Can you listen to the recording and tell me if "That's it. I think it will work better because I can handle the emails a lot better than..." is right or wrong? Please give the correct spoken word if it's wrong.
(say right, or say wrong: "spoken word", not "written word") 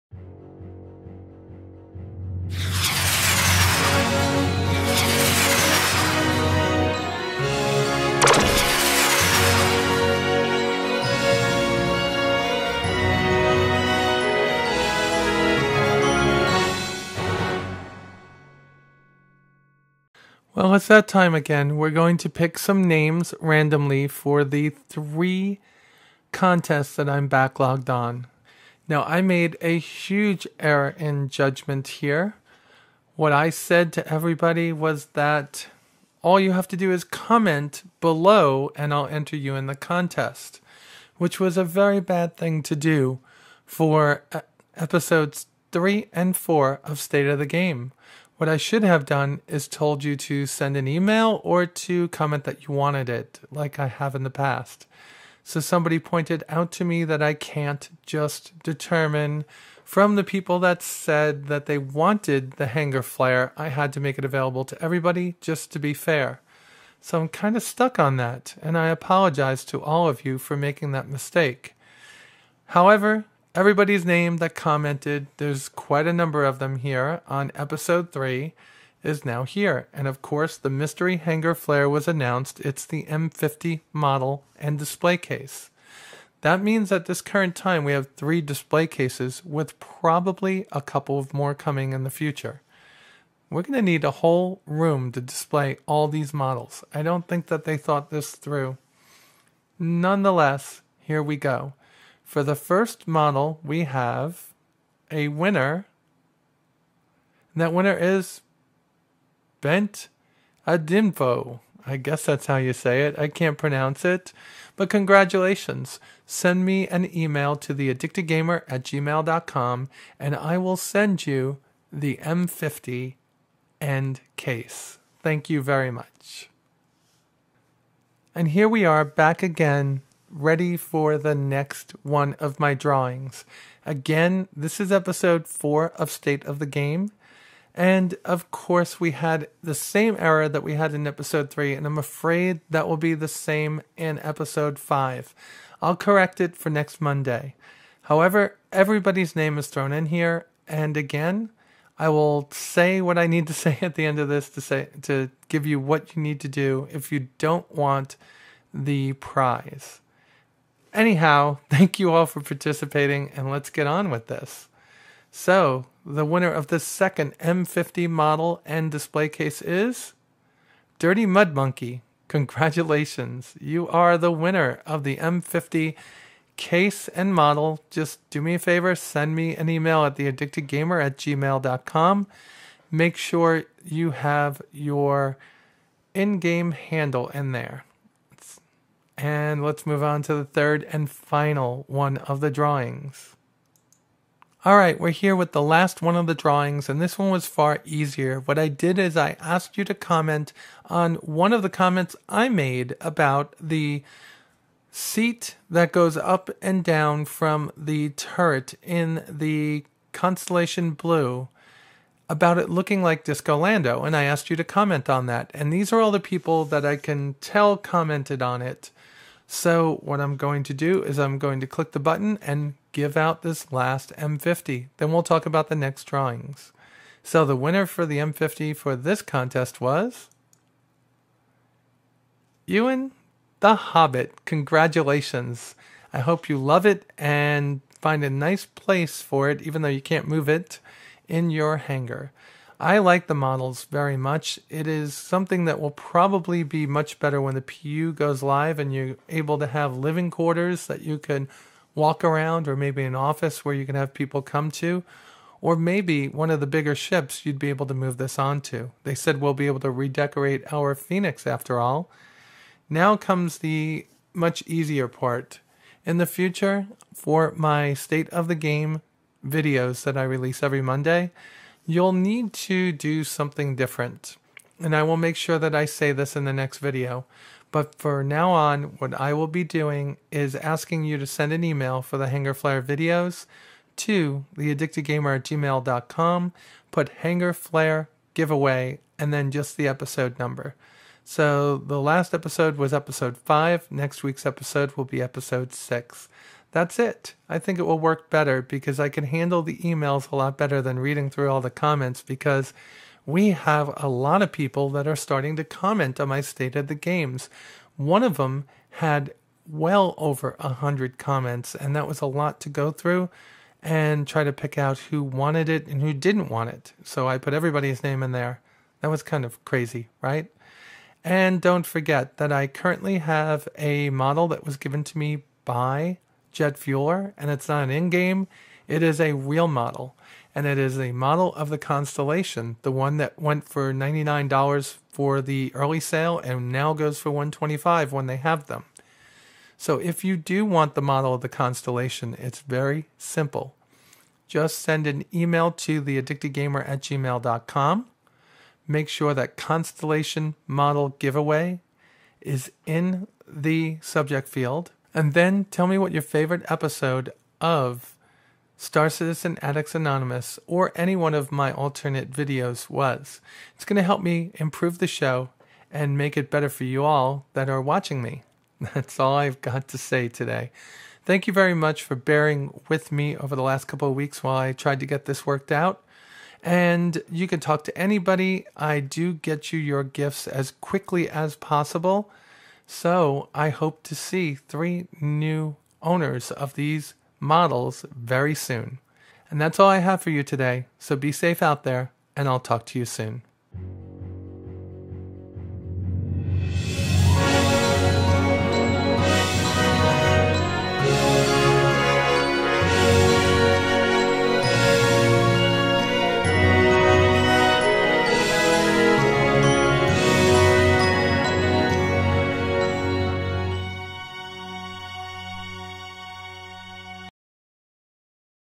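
right.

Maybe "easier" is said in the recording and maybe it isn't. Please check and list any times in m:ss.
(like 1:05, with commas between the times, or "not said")
3:17, 4:24.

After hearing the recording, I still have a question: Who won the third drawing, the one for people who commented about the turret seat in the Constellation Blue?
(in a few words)
Ewan the Hobbit.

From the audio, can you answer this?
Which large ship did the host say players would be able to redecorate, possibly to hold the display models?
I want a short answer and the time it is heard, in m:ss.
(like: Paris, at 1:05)
Phoenix, at 4:20.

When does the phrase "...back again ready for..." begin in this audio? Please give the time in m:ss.
2:09.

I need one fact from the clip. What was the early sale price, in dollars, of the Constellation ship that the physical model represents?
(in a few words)
$99.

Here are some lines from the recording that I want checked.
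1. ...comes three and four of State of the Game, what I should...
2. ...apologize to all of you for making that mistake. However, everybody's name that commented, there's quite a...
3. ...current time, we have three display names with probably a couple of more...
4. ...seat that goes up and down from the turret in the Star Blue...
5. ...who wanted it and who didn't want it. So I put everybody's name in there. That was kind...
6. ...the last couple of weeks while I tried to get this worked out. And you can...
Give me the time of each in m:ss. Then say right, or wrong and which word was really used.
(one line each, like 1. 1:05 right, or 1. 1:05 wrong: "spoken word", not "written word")
1. 0:44 wrong: "episodes", not "comes"
2. 1:08 right
3. 1:27 wrong: "cases", not "names"
4. 3:24 wrong: "Constellation", not "Star"
5. 5:14 right
6. 6:13 right.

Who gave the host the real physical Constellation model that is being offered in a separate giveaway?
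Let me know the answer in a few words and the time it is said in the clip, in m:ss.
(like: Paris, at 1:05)
jet fueler, at 5:26.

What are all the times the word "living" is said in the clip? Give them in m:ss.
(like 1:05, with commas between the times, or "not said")
4:09.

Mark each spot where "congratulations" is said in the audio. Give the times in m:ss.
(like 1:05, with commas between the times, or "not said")
1:54, 2:52, 3:54.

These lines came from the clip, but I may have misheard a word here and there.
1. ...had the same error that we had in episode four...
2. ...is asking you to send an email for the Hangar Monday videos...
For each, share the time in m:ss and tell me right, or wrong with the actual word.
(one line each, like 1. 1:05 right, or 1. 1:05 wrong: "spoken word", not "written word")
1. 2:19 wrong: "three", not "four"
2. 4:40 wrong: "Flair", not "Monday".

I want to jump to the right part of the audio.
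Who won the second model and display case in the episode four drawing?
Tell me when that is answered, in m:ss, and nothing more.
2:50.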